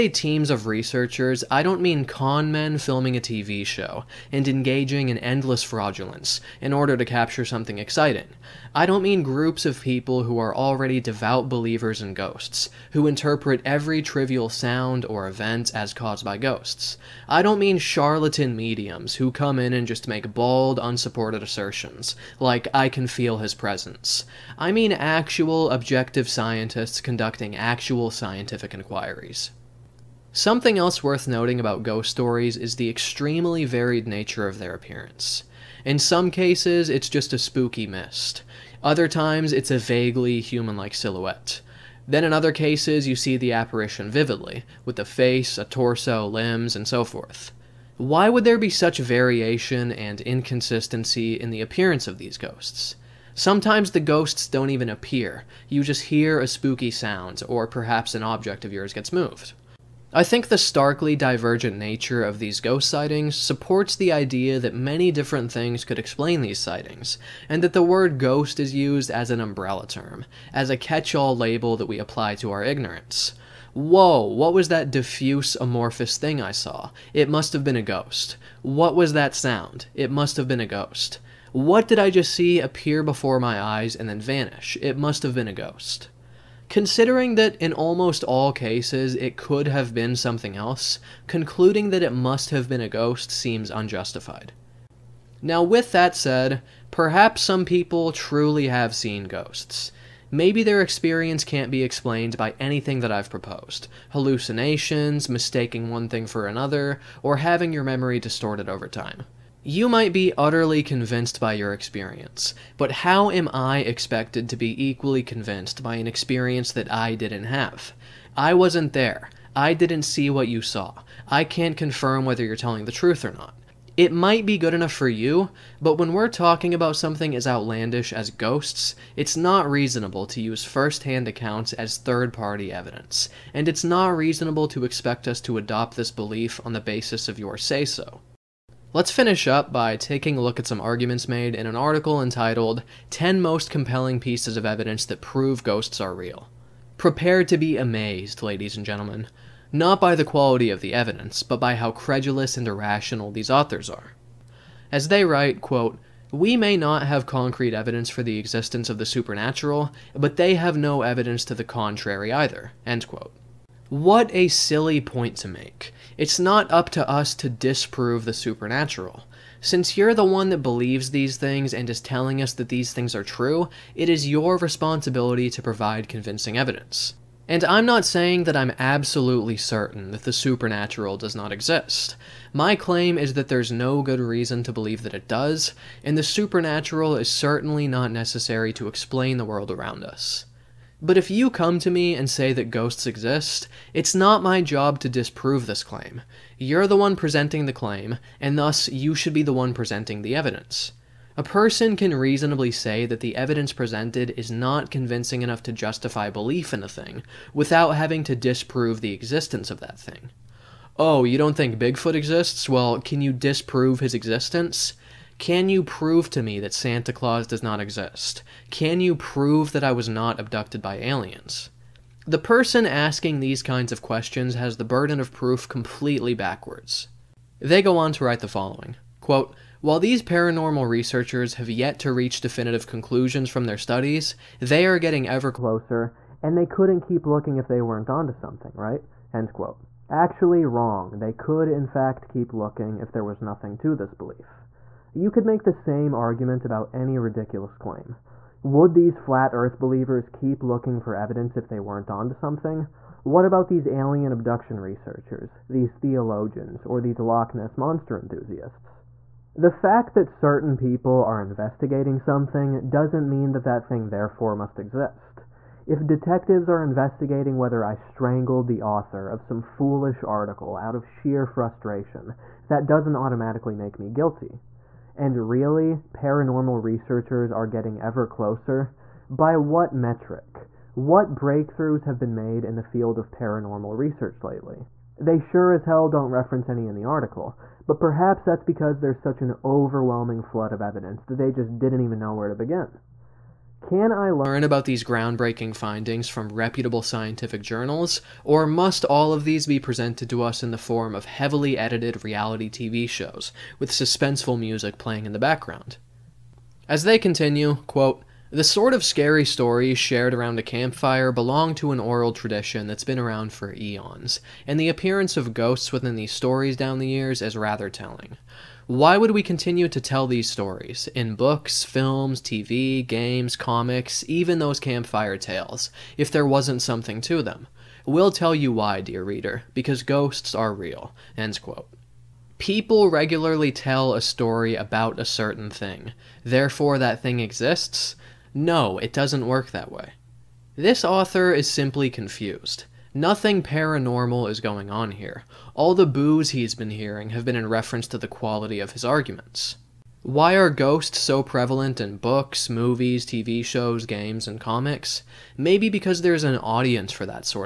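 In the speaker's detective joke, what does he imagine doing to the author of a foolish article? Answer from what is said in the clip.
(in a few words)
strangled.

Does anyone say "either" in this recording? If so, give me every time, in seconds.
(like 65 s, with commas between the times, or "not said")
162 s.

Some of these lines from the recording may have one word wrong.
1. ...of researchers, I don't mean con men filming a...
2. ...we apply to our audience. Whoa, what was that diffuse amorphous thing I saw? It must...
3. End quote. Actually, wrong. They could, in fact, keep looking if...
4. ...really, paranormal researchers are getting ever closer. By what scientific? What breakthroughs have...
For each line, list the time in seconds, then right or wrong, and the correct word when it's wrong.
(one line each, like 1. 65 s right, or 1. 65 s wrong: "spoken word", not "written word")
1. 0 s right
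2. 71 s wrong: "ignorance", not "audience"
3. 239 s right
4. 275 s wrong: "metric", not "scientific".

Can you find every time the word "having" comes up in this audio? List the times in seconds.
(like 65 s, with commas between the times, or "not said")
107 s, 207 s.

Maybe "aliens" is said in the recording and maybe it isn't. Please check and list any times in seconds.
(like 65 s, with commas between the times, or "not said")
220 s, 253 s.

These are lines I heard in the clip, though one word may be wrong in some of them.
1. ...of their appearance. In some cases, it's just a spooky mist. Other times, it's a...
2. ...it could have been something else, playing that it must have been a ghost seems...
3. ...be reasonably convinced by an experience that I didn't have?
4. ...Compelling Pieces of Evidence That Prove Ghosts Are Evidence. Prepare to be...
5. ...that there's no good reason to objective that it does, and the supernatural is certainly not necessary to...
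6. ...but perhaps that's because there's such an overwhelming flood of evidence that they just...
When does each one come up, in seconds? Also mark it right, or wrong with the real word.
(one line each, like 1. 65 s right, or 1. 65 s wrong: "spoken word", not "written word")
1. 34 s right
2. 89 s wrong: "concluding", not "playing"
3. 114 s wrong: "equally", not "reasonably"
4. 143 s wrong: "Real", not "Evidence"
5. 183 s wrong: "believe", not "objective"
6. 287 s right.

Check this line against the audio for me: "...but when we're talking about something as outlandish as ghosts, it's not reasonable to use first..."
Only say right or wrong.
right.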